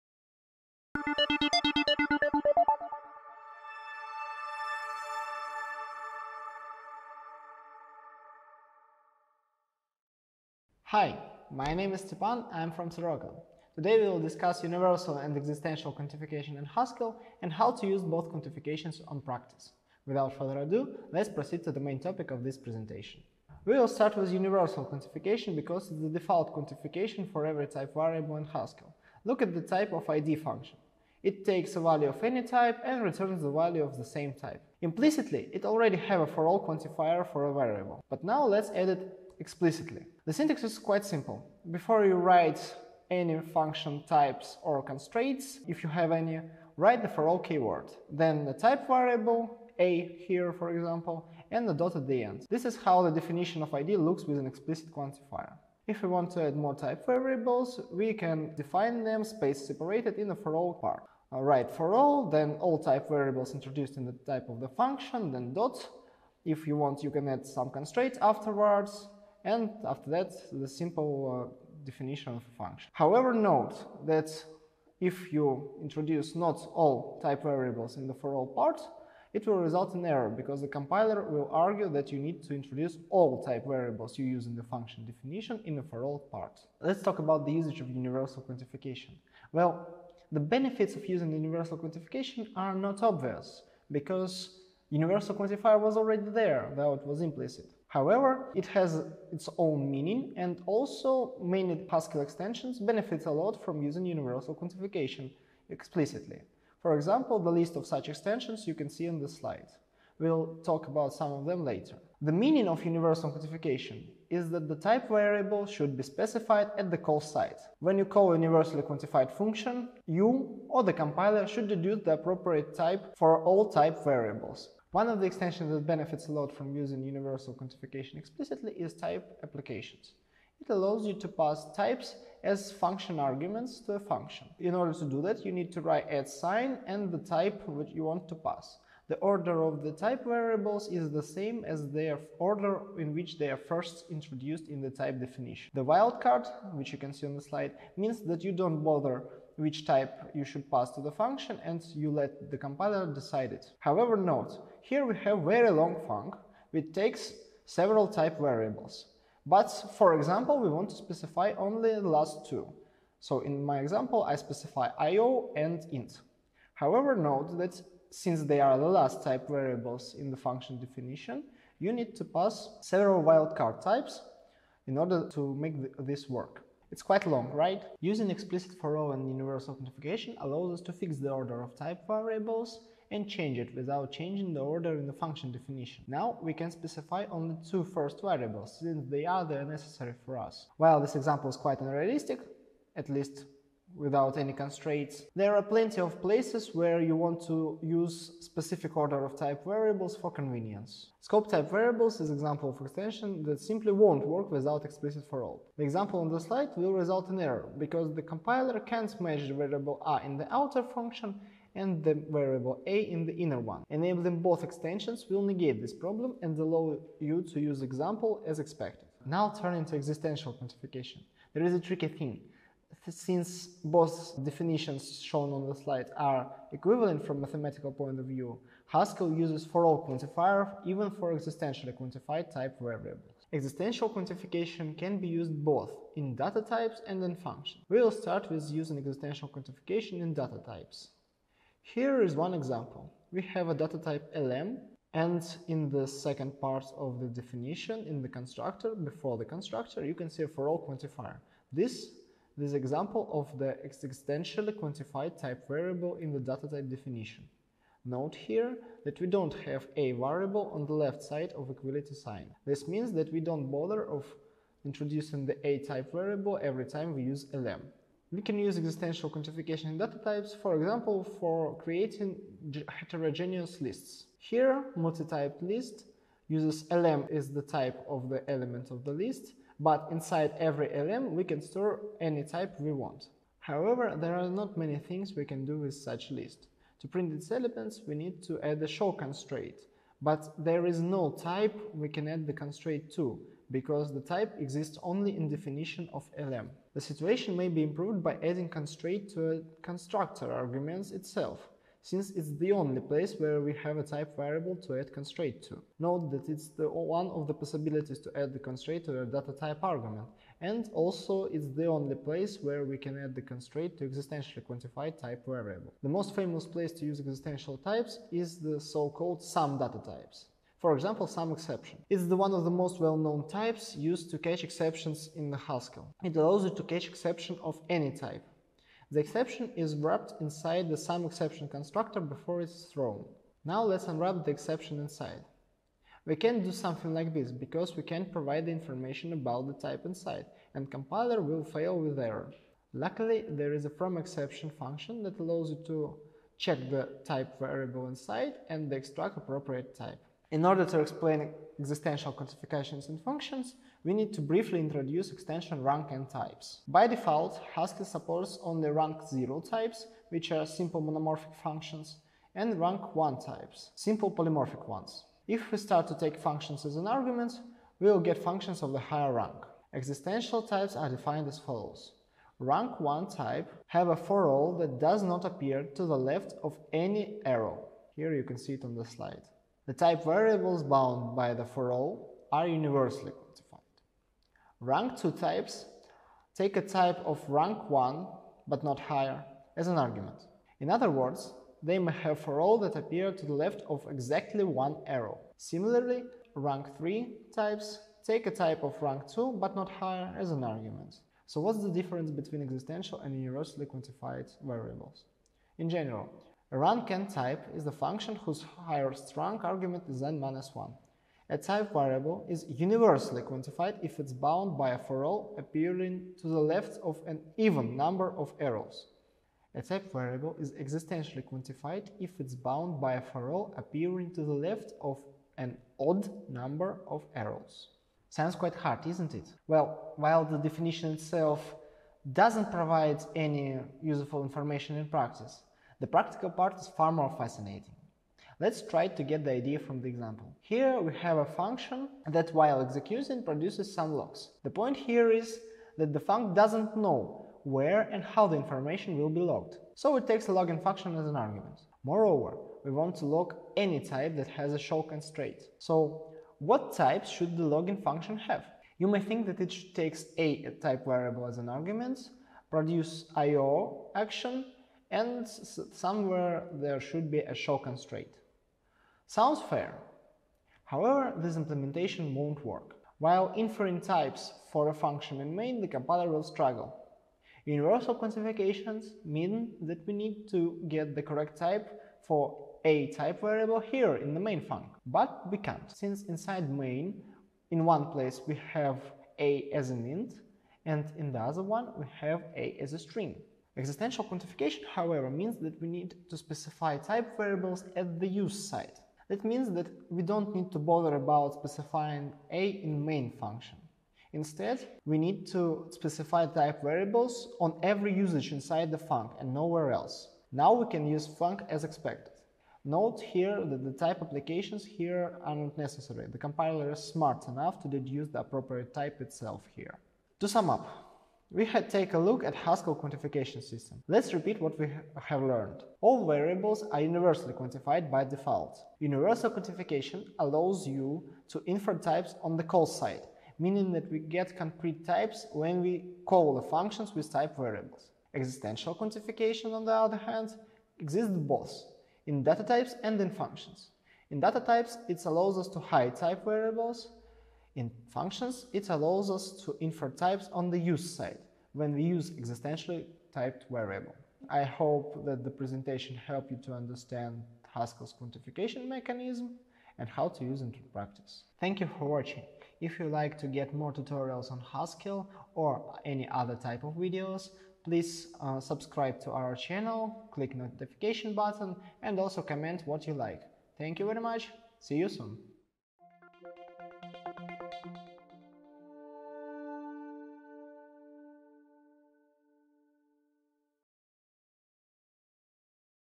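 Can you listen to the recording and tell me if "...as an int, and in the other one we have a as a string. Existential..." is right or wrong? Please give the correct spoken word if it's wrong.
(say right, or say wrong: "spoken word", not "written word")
right.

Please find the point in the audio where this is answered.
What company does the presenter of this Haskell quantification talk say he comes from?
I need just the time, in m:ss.
0:12.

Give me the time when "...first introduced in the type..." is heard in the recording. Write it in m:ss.
2:23.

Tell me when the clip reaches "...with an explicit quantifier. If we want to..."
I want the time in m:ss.
0:54.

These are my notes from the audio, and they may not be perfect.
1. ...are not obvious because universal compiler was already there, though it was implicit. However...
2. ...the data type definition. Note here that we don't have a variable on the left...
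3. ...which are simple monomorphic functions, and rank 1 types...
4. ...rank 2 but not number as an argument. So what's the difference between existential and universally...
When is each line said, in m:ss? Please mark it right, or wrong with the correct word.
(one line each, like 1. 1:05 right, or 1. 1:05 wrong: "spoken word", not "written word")
1. 1:32 wrong: "quantifier", not "compiler"
2. 4:16 right
3. 6:00 right
4. 6:39 wrong: "higher", not "number".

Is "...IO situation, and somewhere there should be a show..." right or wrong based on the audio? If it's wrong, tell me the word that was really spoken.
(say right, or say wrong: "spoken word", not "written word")
wrong: "action", not "situation".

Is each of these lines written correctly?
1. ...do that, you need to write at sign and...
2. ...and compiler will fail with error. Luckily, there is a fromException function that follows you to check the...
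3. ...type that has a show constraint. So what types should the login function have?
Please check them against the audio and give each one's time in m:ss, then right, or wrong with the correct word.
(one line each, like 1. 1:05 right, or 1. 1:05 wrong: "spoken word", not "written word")
1. 2:15 right
2. 5:40 wrong: "allows", not "follows"
3. 7:33 right.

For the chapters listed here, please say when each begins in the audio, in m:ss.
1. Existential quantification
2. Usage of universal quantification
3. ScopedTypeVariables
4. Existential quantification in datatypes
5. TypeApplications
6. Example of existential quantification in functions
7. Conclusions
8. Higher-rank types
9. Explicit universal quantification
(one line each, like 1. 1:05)
1. 3:39
2. 1:26
3. 3:21
4. 4:00
5. 2:05
6. 7:10
7. 8:40
8. 5:50
9. 0:24.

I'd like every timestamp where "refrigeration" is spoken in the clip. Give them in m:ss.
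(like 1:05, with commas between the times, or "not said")
not said.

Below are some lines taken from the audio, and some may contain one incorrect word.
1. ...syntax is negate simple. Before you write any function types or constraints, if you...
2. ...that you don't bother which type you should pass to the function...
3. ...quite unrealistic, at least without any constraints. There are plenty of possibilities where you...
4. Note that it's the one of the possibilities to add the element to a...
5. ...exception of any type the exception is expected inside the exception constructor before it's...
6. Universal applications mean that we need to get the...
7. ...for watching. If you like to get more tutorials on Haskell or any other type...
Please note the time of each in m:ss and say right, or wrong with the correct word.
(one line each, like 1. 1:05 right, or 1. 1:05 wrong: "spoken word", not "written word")
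1. 0:40 wrong: "quite", not "negate"
2. 2:28 right
3. 3:11 wrong: "places", not "possibilities"
4. 5:05 wrong: "constraint", not "element"
5. 5:27 wrong: "wrapped", not "expected"
6. 7:57 wrong: "quantifications", not "applications"
7. 9:21 right.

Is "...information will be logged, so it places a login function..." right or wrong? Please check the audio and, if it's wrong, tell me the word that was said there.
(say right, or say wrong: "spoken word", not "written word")
wrong: "takes", not "places".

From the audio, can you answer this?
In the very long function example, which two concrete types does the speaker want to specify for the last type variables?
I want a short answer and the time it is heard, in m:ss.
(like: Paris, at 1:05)
IO and Int, at 2:44.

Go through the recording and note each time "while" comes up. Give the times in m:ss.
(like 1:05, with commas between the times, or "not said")
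3:10, 7:10, 7:22, 7:53.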